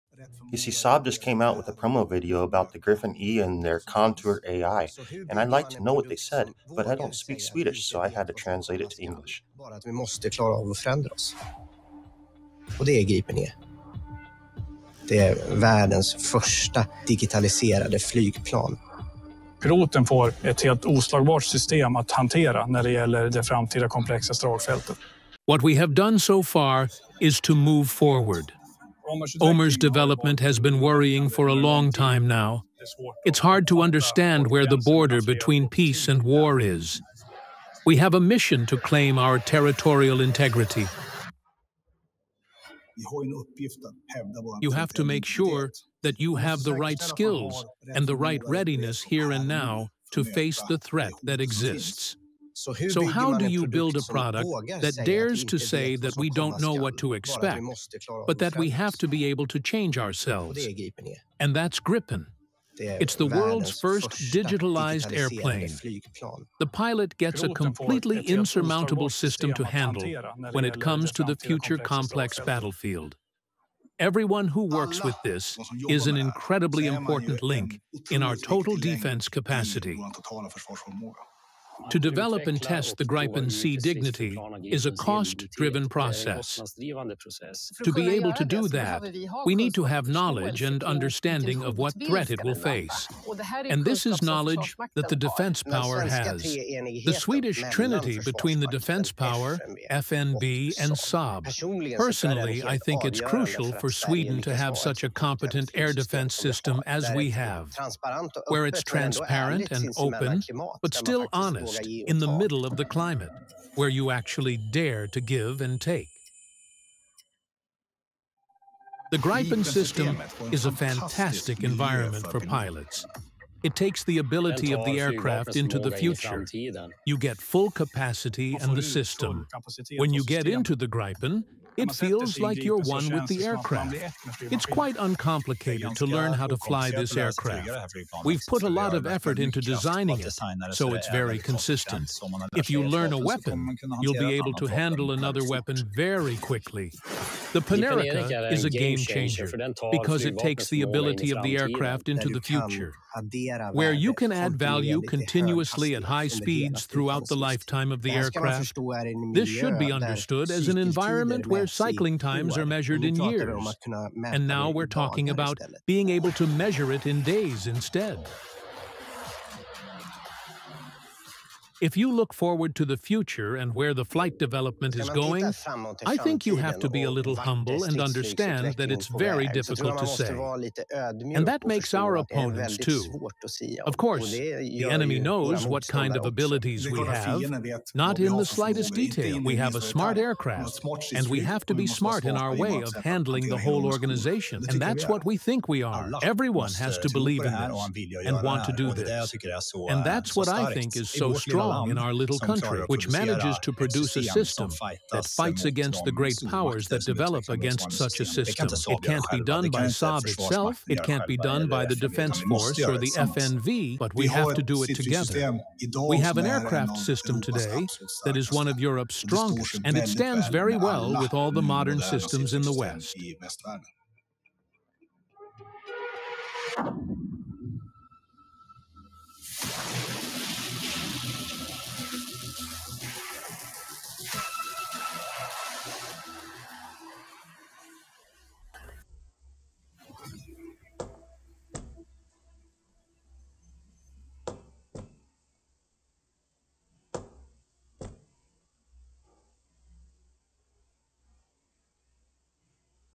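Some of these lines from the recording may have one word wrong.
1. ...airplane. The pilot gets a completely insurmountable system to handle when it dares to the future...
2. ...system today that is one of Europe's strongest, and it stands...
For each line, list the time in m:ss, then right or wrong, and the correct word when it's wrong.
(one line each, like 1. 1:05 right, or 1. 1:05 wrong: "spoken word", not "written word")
1. 1:05 wrong: "comes", not "dares"
2. 3:36 right.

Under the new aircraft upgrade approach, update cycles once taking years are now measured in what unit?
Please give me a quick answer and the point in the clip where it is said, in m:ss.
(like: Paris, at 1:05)
days, at 2:47.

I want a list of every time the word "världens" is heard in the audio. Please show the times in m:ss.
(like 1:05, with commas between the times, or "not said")
0:15.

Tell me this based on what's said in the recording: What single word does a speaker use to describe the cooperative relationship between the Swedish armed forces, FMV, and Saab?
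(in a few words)
trinity.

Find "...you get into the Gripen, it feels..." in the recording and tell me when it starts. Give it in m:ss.
2:10.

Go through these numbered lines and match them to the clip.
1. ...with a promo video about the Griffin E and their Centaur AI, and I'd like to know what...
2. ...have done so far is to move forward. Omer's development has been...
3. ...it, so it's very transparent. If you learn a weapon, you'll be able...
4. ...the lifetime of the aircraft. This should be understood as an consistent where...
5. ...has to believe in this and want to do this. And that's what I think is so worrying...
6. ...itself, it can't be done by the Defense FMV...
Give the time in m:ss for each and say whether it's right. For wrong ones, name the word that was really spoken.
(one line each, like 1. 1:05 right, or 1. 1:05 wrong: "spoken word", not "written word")
1. 0:01 right
2. 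0:25 right
3. 2:20 wrong: "consistent", not "transparent"
4. 2:37 wrong: "environment", not "consistent"
5. 3:16 wrong: "strong", not "worrying"
6. 3:30 wrong: "Force", not "FMV".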